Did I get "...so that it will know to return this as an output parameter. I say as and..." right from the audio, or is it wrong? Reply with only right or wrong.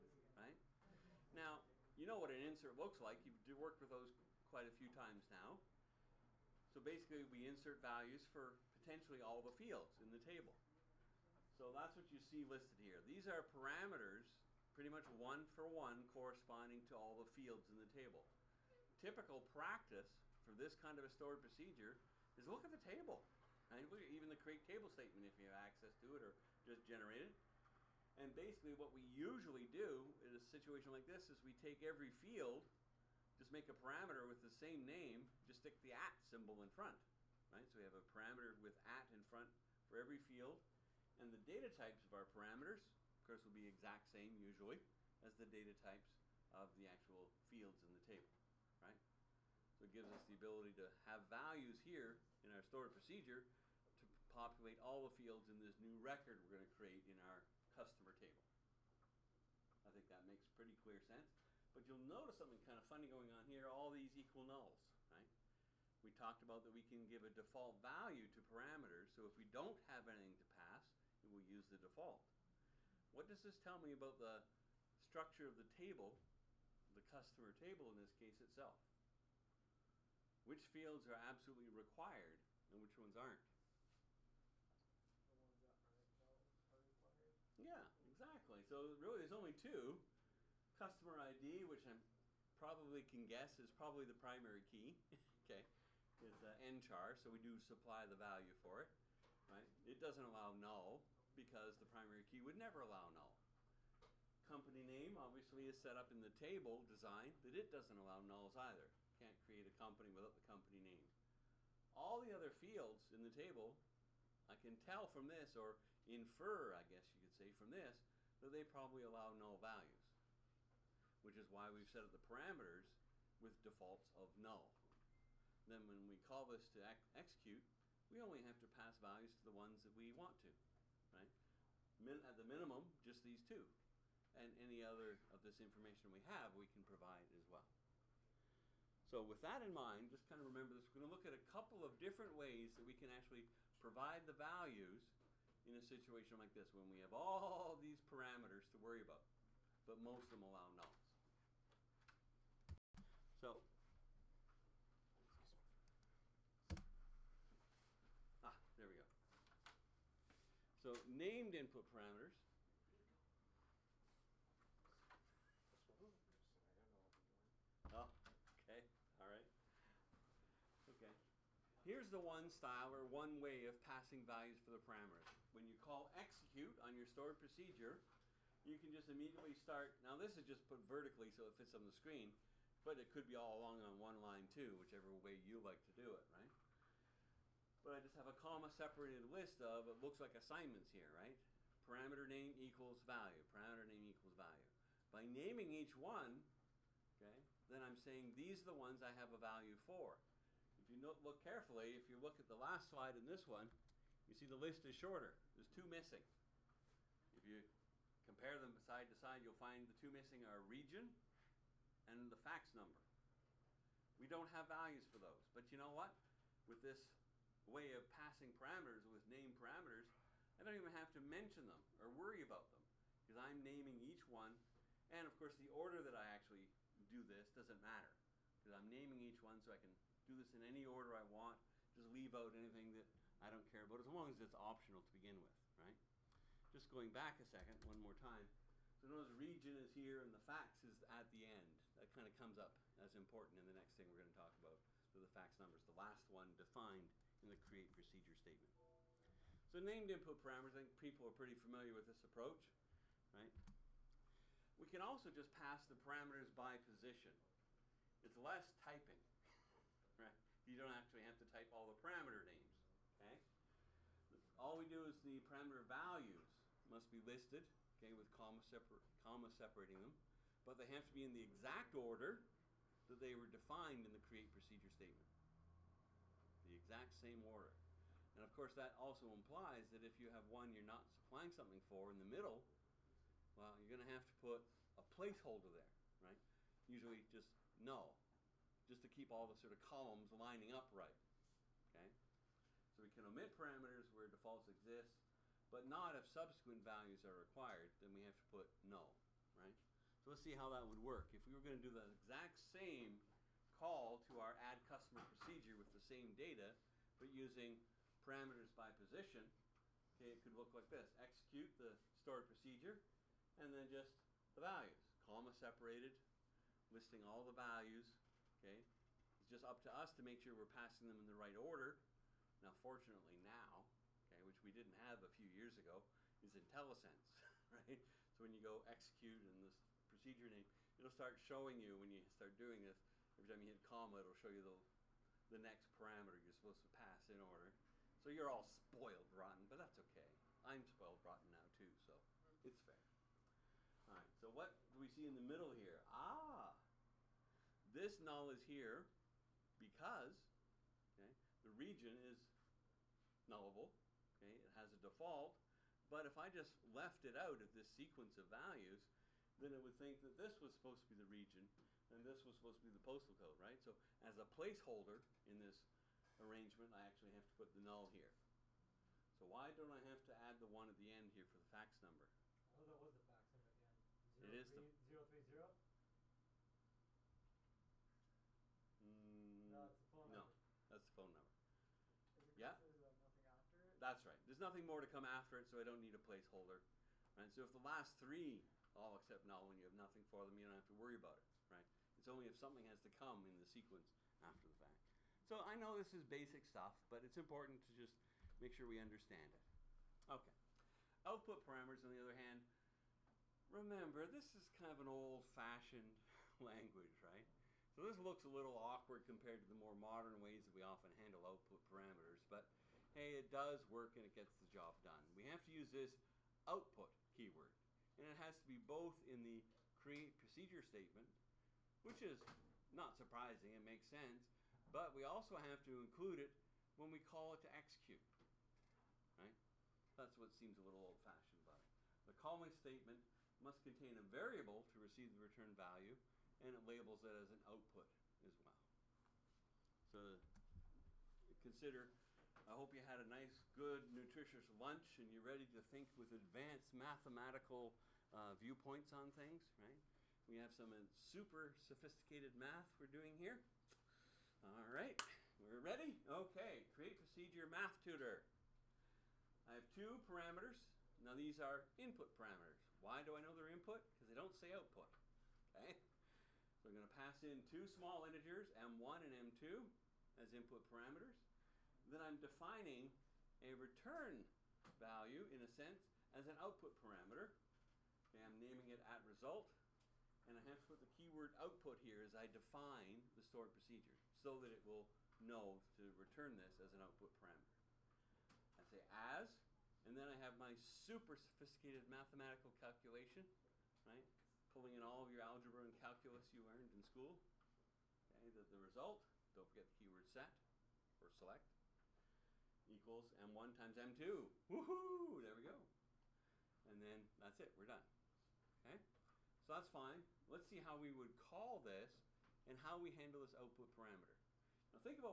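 right.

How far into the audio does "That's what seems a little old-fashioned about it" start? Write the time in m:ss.
7:10.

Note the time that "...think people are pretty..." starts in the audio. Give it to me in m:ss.
4:10.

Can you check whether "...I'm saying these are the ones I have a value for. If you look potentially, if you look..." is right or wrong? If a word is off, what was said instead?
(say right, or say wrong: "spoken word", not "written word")
wrong: "carefully", not "potentially".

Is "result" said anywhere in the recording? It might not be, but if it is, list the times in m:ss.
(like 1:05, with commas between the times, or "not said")
7:59, 8:18.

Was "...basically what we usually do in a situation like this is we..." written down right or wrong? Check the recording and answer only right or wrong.
right.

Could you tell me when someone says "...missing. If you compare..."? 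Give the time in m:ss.
3:25.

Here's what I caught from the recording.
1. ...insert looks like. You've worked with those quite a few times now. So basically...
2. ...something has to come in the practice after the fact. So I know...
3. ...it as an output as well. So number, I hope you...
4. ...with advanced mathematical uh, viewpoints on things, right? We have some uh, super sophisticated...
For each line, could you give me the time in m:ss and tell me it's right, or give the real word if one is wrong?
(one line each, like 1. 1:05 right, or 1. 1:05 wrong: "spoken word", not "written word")
1. 0:02 right
2. 6:32 wrong: "sequence", not "practice"
3. 7:17 wrong: "consider", not "number"
4. 7:26 right.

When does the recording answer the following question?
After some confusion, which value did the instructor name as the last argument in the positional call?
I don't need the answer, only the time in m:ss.
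6:21.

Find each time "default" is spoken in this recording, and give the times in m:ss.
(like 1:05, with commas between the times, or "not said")
1:07, 1:11, 2:03, 4:54, 5:54.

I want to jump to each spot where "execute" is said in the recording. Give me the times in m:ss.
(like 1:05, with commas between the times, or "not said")
2:07, 2:56, 5:11, 5:28, 7:07.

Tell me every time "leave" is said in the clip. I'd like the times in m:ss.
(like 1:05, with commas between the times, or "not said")
3:52.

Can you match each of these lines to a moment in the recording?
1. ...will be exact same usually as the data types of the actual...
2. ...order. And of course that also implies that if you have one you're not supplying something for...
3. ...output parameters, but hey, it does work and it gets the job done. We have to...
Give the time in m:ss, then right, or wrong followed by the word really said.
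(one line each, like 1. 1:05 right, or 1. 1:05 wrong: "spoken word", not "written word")
1. 0:43 right
2. 4:37 right
3. 6:51 right.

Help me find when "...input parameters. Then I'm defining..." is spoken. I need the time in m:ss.
7:50.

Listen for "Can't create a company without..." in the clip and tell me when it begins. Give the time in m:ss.
1:49.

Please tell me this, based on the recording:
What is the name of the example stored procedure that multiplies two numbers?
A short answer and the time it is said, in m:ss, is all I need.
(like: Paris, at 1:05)
Math tutor, at 7:37.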